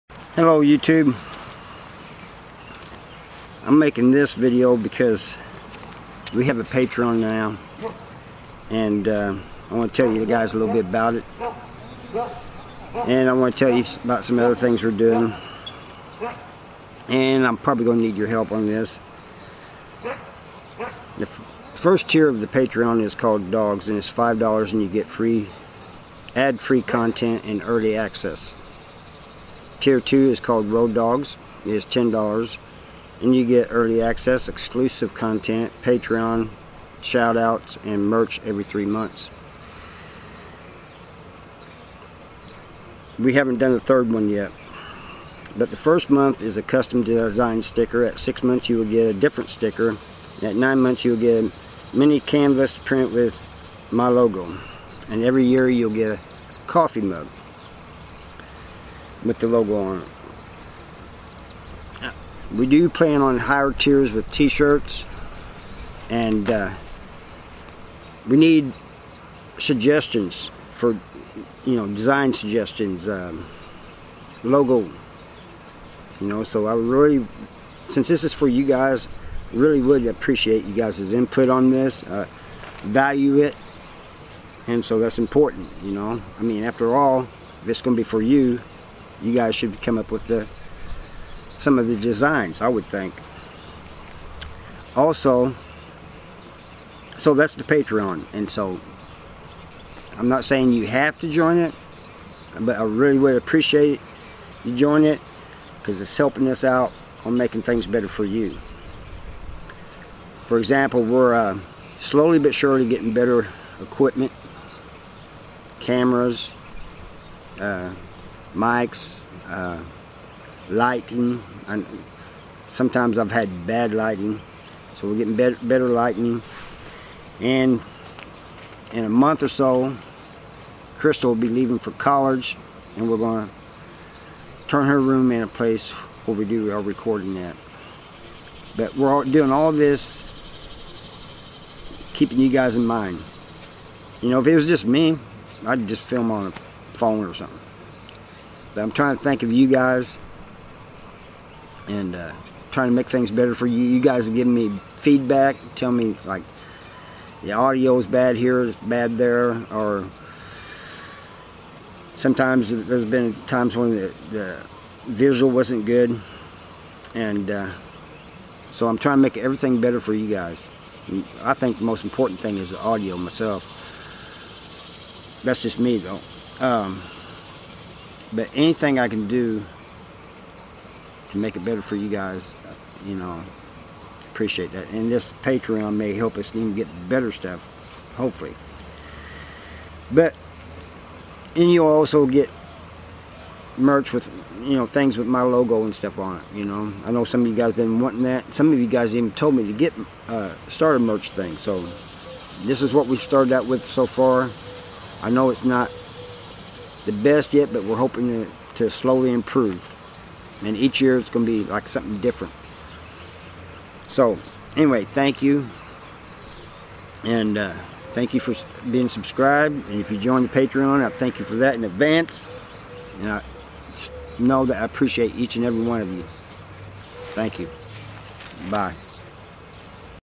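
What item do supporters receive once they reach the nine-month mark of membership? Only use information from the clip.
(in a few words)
mini canvas print.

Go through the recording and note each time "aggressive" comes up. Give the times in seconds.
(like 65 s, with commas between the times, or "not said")
not said.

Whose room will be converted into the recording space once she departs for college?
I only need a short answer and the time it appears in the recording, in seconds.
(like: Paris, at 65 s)
Crystal, at 130 s.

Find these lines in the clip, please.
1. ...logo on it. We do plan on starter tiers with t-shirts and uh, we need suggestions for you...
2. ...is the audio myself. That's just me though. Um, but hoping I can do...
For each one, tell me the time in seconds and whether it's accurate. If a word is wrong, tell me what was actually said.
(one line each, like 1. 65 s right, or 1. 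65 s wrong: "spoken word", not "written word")
1. 59 s wrong: "higher", not "starter"
2. 172 s wrong: "anything", not "hoping".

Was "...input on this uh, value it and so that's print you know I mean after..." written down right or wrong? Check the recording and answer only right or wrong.
wrong.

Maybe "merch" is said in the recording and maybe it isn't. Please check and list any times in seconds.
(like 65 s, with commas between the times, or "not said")
38 s, 193 s, 200 s.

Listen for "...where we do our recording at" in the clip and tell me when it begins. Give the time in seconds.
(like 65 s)
136 s.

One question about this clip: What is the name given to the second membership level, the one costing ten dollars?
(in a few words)
Road Dogs.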